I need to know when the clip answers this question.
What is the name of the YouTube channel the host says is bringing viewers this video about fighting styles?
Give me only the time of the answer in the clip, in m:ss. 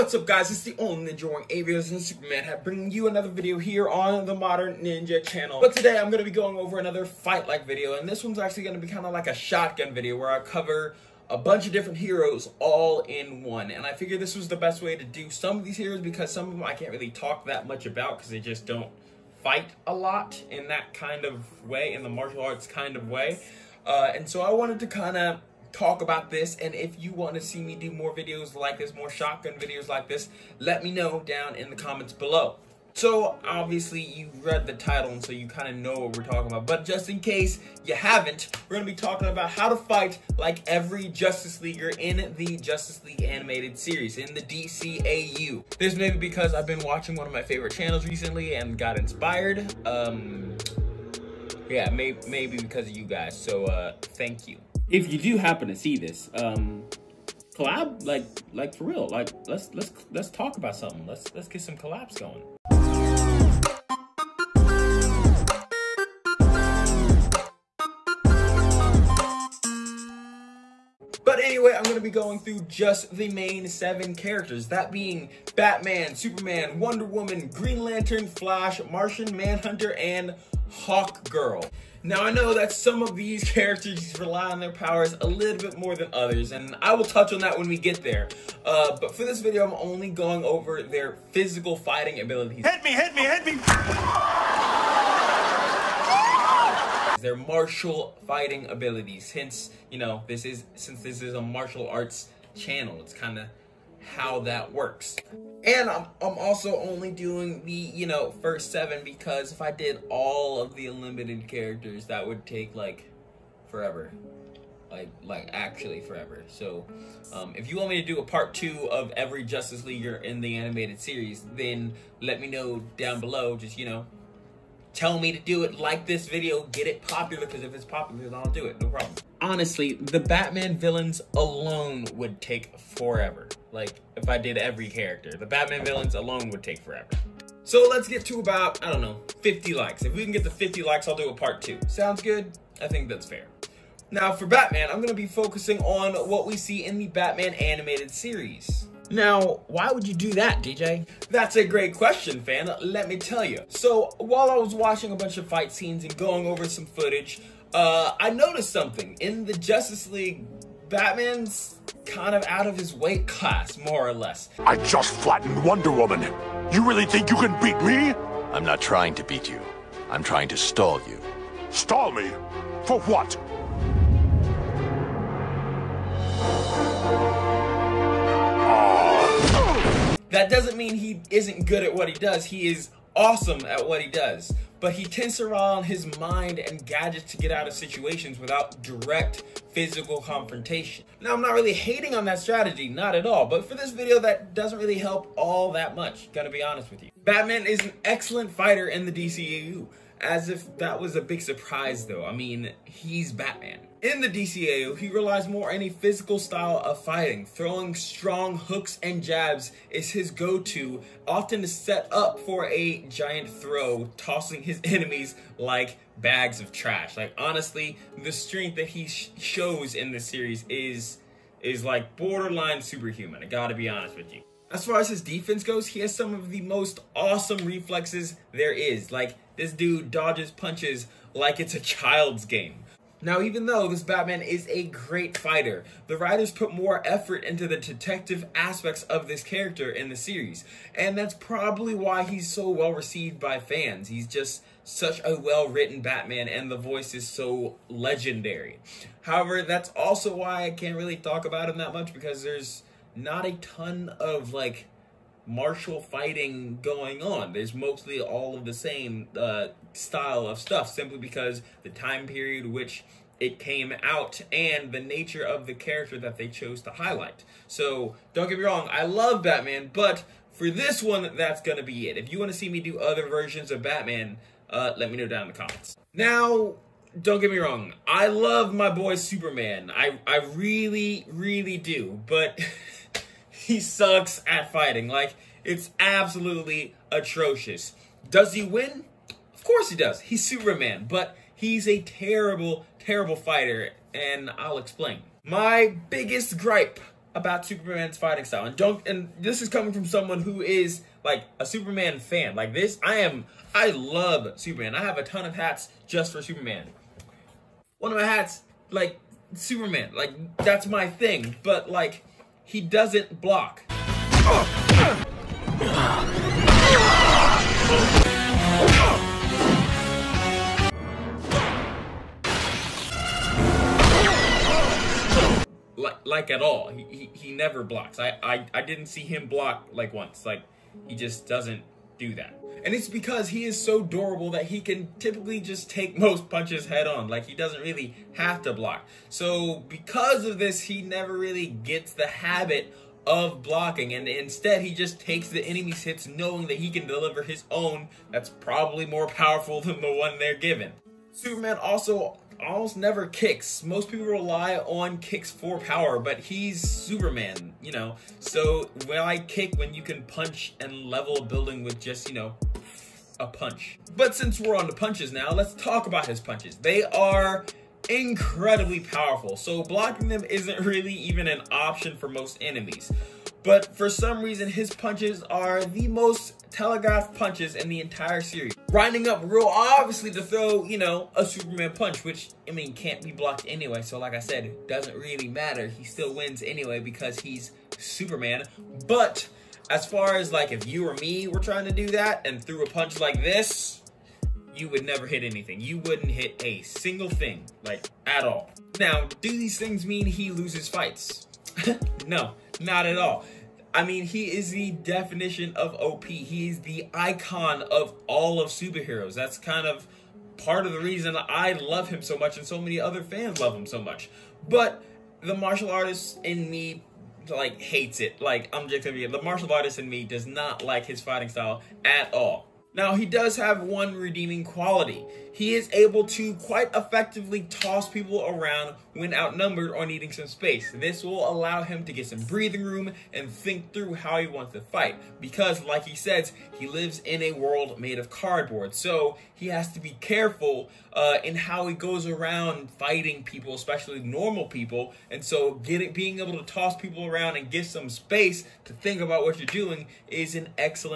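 0:04.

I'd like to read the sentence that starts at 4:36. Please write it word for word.
Now, don't get me wrong, I love my boy Superman.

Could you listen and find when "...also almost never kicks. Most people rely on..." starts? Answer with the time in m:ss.
5:51.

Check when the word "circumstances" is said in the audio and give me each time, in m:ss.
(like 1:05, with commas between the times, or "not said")
not said.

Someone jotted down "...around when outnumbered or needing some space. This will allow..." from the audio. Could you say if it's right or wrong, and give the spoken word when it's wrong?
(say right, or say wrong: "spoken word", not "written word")
right.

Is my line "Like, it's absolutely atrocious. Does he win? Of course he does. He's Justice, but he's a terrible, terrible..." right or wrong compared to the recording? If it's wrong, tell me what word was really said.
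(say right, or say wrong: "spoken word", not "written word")
wrong: "Superman", not "Justice".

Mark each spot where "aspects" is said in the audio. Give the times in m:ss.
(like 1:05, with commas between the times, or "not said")
3:58.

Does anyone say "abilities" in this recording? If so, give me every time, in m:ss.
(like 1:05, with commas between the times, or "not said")
1:32, 1:38.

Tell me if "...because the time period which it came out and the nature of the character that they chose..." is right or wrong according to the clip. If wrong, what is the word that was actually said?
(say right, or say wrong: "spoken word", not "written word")
right.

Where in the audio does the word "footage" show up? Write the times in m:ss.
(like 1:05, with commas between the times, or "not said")
2:36.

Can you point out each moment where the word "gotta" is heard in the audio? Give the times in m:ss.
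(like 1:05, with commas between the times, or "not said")
3:16, 3:43.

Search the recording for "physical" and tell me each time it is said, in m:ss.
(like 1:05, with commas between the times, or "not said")
1:31, 3:09, 3:25.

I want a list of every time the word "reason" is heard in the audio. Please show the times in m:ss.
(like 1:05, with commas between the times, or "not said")
6:14, 6:50.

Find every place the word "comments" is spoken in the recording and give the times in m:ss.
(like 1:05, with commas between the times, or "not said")
0:31, 4:35.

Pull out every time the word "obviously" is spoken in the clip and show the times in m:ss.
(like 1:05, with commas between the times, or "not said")
0:33, 6:19.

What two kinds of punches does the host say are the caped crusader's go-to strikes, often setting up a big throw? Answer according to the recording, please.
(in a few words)
hooks and jabs.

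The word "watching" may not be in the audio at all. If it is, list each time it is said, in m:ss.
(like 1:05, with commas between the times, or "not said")
0:46, 2:34.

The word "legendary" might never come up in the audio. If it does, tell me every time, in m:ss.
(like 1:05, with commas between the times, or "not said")
4:07.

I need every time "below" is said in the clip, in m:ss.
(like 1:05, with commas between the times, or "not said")
0:32, 2:03.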